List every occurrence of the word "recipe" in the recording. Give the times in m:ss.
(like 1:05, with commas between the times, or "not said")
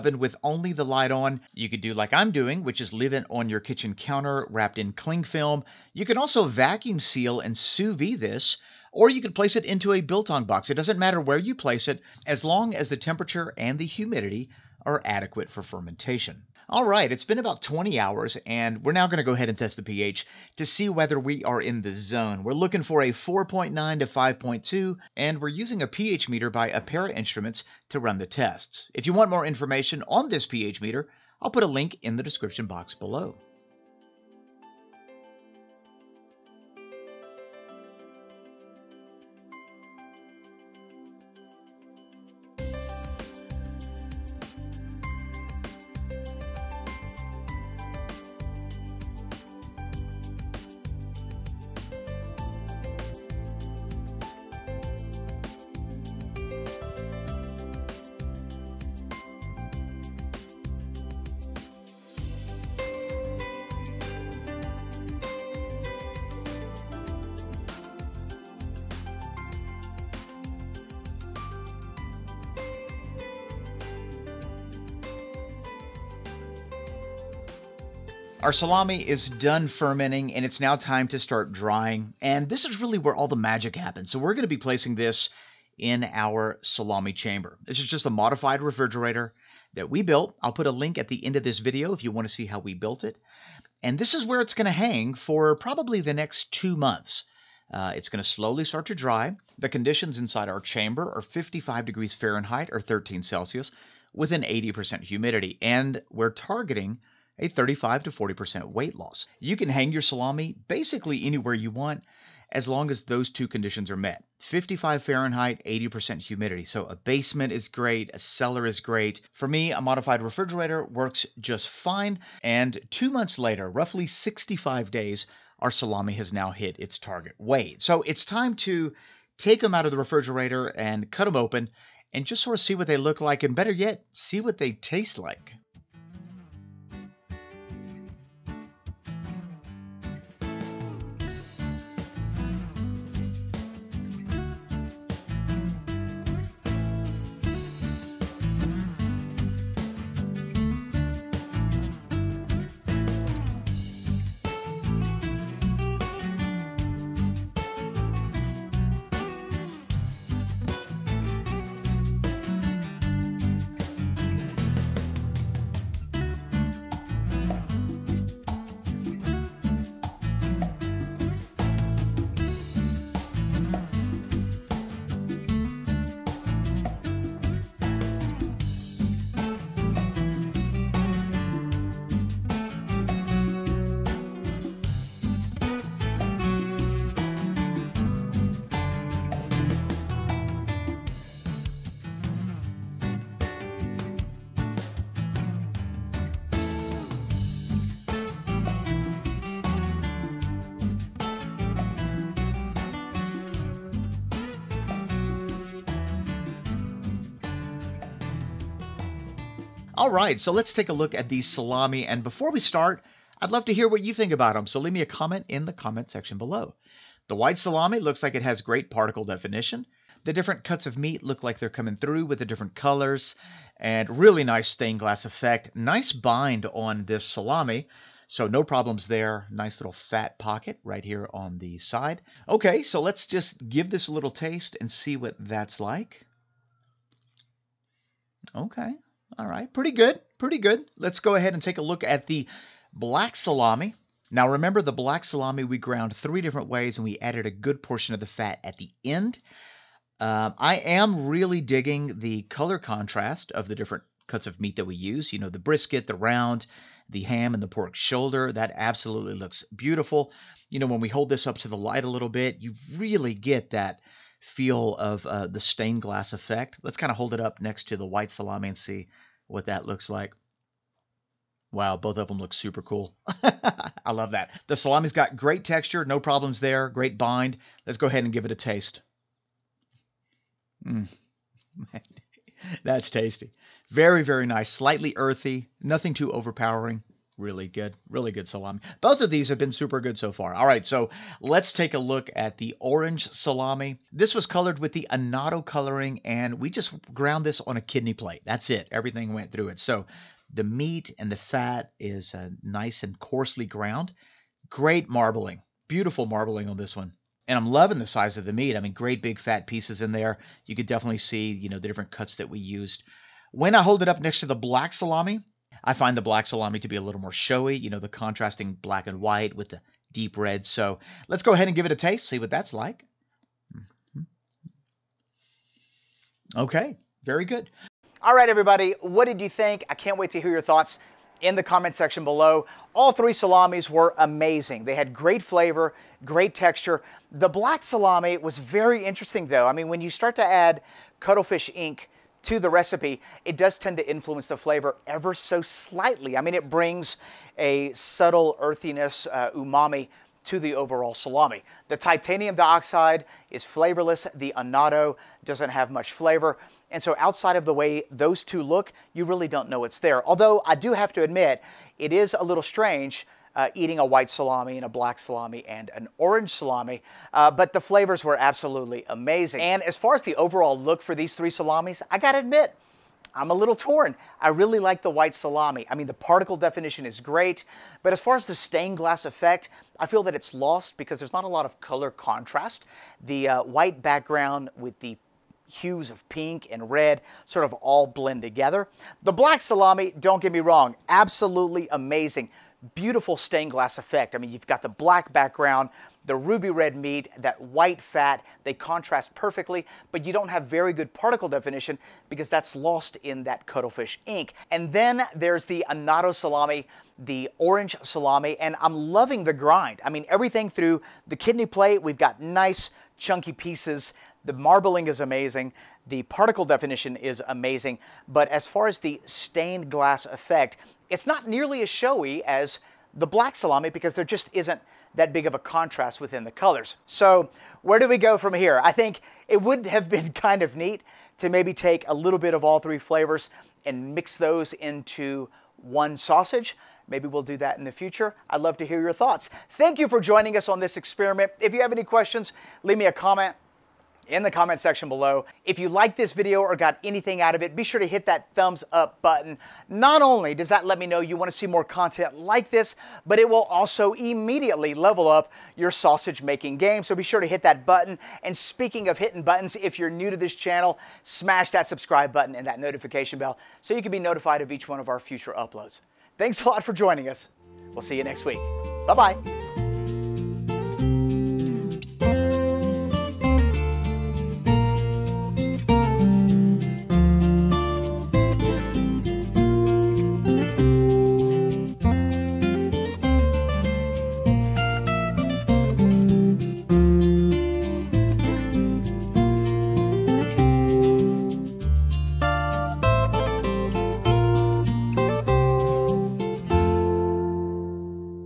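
5:42.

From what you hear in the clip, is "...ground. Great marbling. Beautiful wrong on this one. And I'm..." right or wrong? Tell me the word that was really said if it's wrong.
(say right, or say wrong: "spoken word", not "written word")
wrong: "marbling", not "wrong".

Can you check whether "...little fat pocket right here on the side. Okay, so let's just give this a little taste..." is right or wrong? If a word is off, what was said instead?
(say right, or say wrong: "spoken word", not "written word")
right.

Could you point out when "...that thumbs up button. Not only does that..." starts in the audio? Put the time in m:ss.
7:28.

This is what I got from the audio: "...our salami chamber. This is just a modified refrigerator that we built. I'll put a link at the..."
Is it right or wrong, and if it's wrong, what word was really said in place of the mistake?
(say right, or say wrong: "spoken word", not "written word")
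right.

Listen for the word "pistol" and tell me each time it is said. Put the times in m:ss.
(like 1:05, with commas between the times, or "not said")
not said.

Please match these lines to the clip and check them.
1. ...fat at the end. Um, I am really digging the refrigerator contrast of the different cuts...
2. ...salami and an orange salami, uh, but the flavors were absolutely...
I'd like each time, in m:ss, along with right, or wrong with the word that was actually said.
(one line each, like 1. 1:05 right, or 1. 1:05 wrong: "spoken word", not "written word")
1. 4:08 wrong: "color", not "refrigerator"
2. 6:05 right.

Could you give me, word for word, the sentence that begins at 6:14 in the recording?
I really like the white salami.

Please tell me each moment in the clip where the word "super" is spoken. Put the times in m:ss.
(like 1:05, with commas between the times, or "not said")
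4:32, 4:49.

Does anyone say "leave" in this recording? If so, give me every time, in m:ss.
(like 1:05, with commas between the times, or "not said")
0:02, 3:34, 7:22.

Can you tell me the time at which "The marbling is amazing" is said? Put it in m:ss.
6:54.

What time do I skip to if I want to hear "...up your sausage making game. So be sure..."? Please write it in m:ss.
7:35.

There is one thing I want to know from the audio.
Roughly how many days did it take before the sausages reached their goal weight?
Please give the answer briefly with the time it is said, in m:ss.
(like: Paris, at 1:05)
65, at 2:04.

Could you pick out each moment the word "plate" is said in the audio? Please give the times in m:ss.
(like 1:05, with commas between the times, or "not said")
4:58, 6:51.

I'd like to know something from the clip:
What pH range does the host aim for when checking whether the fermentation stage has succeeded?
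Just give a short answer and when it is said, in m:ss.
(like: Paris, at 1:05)
4.9 to 5.2, at 0:23.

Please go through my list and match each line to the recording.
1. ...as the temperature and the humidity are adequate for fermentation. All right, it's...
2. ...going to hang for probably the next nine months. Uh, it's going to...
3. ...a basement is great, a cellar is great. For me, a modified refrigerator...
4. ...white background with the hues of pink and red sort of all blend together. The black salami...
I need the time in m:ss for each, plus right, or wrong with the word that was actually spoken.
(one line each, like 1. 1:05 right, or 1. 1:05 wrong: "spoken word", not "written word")
1. 0:12 right
2. 1:34 wrong: "two", not "nine"
3. 1:56 right
4. 6:23 right.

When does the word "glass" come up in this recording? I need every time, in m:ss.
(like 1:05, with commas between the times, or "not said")
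3:44, 4:26, 6:18, 6:33, 6:59.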